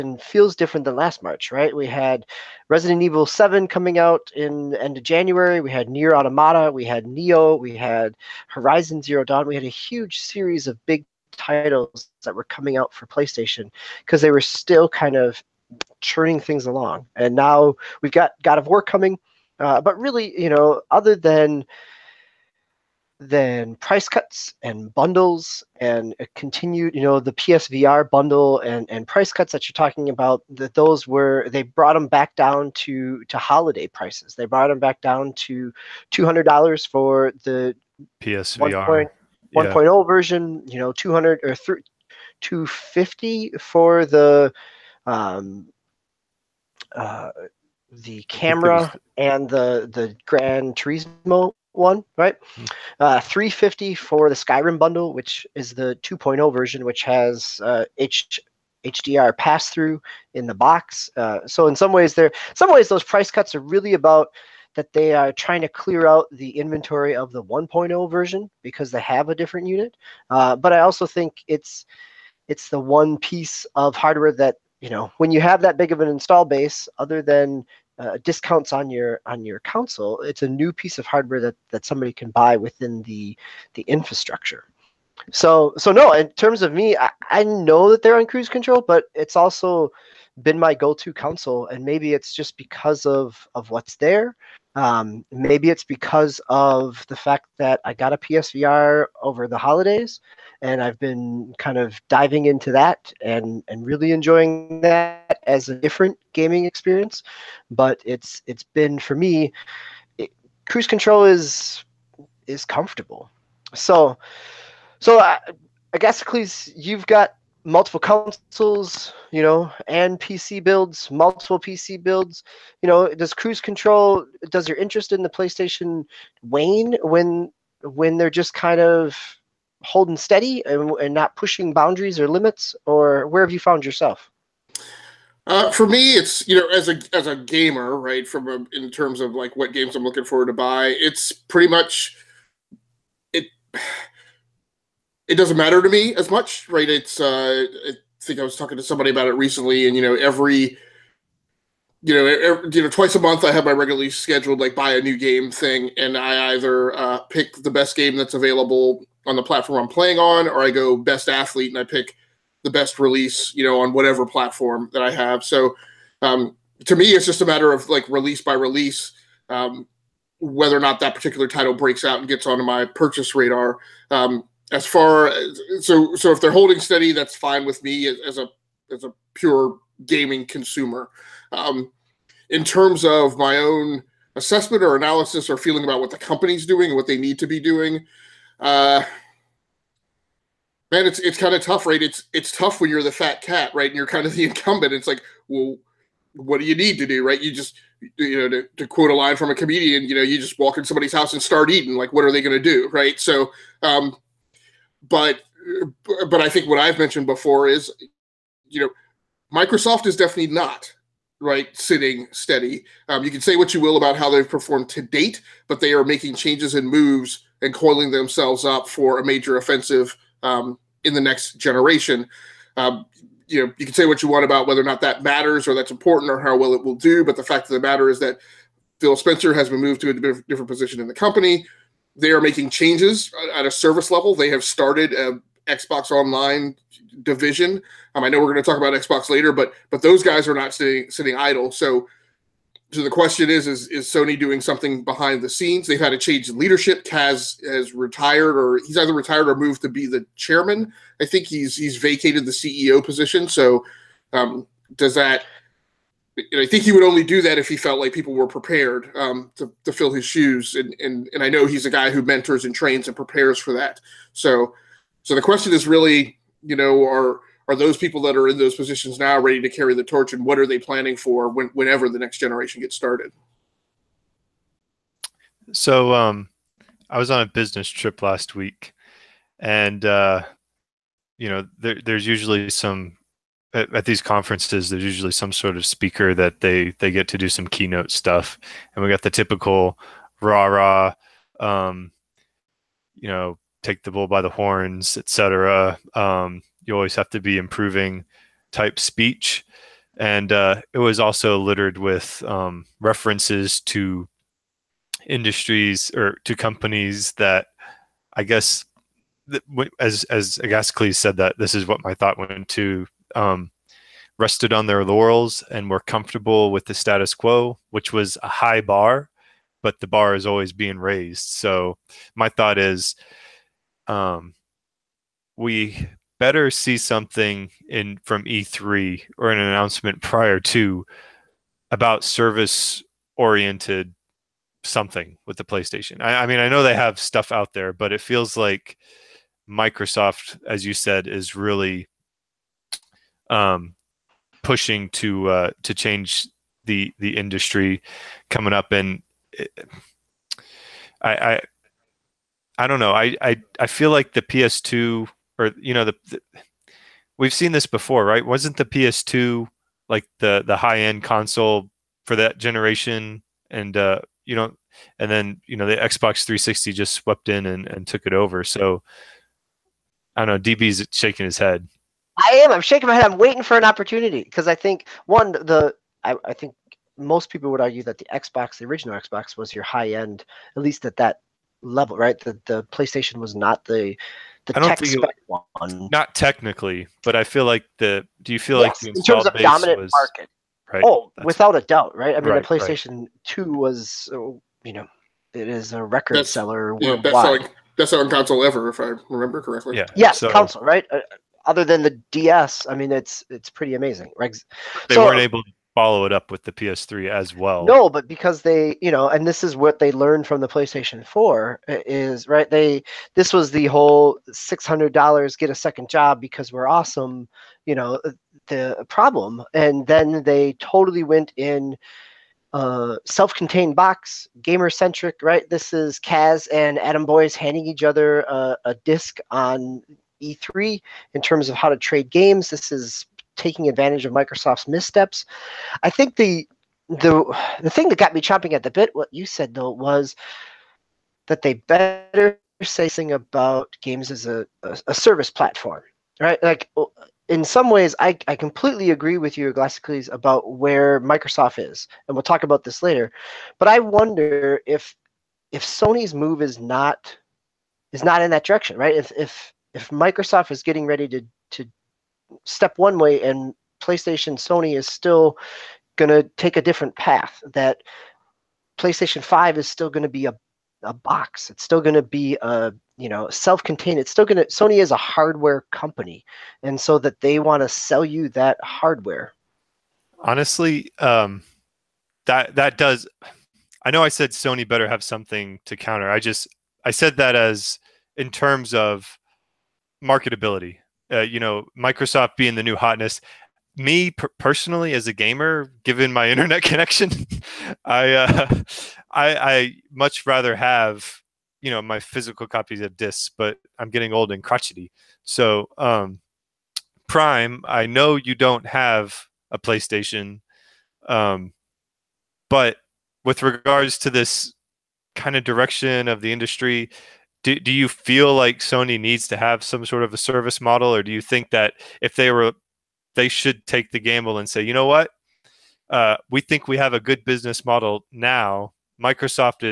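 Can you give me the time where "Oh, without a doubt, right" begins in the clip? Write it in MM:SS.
06:31.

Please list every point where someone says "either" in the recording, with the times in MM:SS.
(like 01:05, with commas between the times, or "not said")
02:36, 04:08.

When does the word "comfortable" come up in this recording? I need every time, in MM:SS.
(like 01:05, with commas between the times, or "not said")
01:52, 05:16.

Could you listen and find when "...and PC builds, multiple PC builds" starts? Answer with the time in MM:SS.
01:59.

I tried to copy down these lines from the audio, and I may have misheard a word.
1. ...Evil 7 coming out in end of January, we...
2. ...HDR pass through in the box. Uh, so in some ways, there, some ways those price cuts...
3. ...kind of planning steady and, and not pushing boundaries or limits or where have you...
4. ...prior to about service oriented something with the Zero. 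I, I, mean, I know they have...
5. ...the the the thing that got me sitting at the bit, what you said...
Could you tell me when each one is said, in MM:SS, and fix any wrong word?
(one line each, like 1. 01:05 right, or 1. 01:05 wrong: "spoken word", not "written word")
1. 00:03 right
2. 00:58 right
3. 02:08 wrong: "holding", not "planning"
4. 05:30 wrong: "PlayStation", not "Zero"
5. 07:16 wrong: "chomping", not "sitting".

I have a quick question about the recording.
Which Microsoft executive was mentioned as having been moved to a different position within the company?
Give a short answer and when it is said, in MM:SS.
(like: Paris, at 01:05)
Phil Spencer, at 03:48.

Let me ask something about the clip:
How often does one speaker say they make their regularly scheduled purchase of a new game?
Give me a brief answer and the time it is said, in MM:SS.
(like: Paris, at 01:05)
Twice a month, at 02:32.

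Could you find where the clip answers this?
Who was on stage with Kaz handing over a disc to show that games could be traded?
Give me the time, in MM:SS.
07:07.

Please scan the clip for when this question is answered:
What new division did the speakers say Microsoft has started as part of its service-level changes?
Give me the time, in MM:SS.
03:55.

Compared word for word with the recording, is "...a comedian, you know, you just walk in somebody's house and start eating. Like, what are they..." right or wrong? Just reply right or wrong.
right.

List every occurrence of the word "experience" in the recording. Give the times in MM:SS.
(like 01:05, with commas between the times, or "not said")
01:46.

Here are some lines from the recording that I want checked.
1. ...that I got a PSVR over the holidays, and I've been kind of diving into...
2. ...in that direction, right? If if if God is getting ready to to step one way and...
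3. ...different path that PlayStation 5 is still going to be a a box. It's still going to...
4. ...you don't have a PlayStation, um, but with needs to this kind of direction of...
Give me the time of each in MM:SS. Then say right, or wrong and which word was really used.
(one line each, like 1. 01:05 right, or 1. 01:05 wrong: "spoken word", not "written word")
1. 01:37 right
2. 07:38 wrong: "Microsoft", not "God"
3. 07:46 right
4. 08:28 wrong: "regards", not "needs".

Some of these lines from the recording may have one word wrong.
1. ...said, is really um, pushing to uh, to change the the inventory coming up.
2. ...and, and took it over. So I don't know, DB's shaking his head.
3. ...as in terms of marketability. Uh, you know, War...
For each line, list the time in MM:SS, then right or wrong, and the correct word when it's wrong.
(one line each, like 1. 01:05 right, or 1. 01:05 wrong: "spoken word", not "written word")
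1. 05:40 wrong: "industry", not "inventory"
2. 06:07 right
3. 08:07 wrong: "Microsoft", not "War".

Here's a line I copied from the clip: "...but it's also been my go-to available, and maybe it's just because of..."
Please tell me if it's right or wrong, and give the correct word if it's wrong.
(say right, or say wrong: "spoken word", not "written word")
wrong: "console", not "available".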